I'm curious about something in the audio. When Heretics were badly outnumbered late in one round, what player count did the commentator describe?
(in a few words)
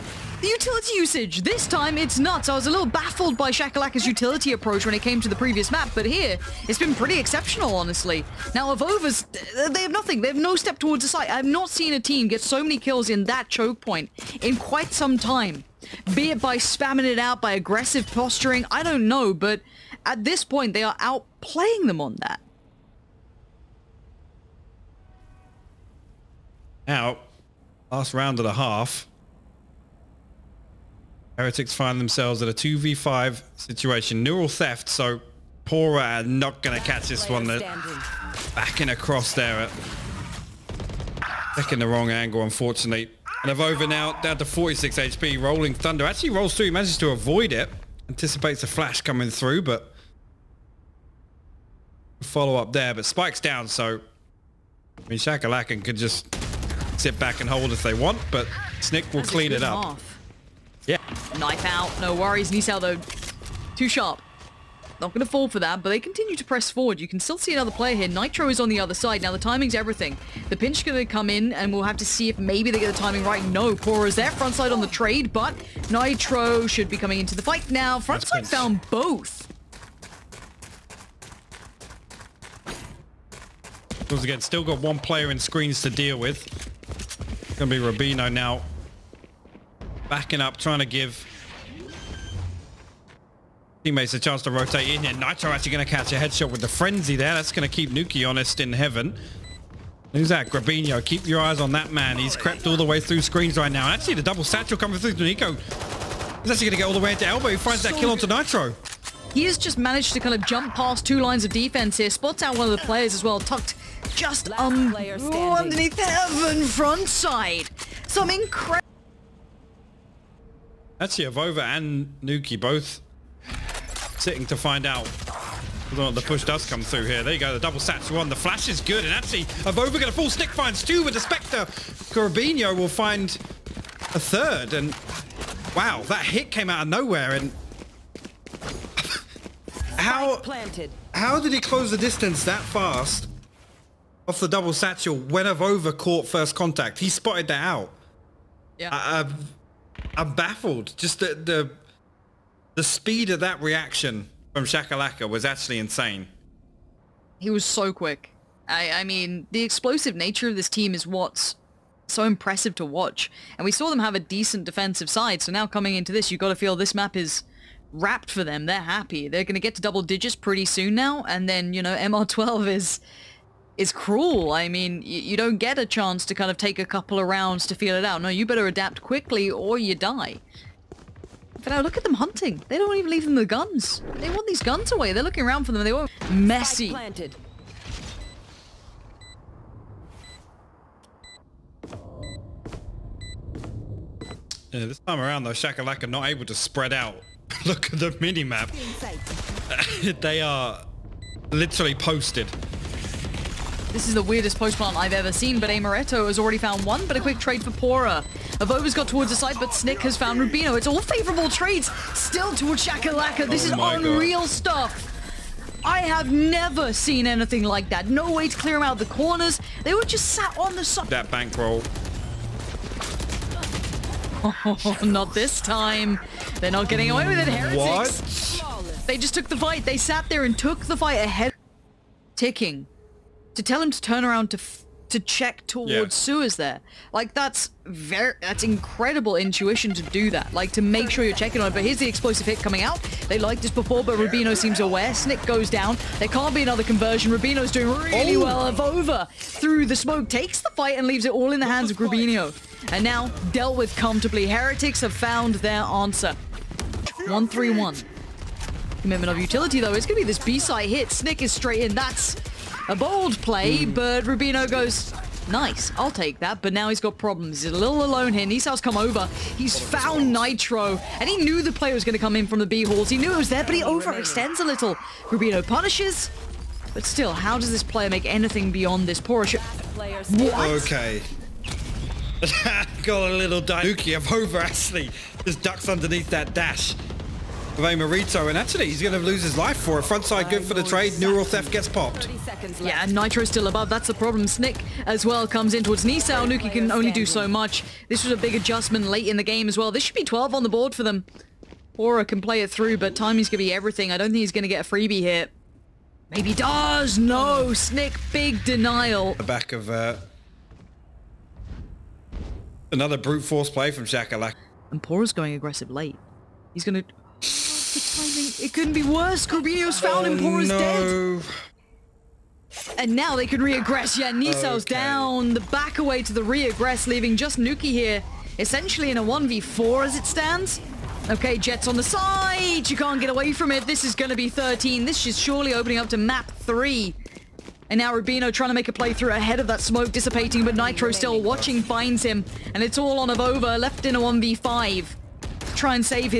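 2v5.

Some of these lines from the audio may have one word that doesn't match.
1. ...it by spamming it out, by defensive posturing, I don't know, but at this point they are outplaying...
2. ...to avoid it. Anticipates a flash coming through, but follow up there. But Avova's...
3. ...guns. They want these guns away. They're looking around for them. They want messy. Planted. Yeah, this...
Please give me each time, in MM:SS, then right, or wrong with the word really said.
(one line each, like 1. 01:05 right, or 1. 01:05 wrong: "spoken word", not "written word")
1. 00:16 wrong: "aggressive", not "defensive"
2. 00:46 wrong: "Spike", not "Avova"
3. 03:03 right.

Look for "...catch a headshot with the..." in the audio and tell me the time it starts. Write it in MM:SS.
01:35.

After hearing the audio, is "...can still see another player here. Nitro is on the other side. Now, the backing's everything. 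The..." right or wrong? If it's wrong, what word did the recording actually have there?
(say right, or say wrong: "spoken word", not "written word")
wrong: "timing", not "backing".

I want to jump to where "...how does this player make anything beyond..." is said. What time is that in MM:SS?
04:37.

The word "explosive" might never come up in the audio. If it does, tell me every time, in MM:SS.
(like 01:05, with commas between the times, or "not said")
02:39, 04:02.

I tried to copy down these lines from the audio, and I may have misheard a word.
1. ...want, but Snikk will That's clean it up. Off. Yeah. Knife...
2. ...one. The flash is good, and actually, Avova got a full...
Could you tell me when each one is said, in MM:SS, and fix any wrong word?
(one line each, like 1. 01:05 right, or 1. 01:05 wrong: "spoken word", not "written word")
1. 00:57 right
2. 02:08 right.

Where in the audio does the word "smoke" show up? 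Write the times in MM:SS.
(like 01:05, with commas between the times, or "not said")
04:09, 05:39.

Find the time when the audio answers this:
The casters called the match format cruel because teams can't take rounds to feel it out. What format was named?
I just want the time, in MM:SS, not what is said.
02:51.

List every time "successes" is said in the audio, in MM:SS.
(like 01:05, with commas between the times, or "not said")
not said.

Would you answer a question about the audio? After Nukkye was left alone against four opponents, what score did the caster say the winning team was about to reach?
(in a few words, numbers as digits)
13.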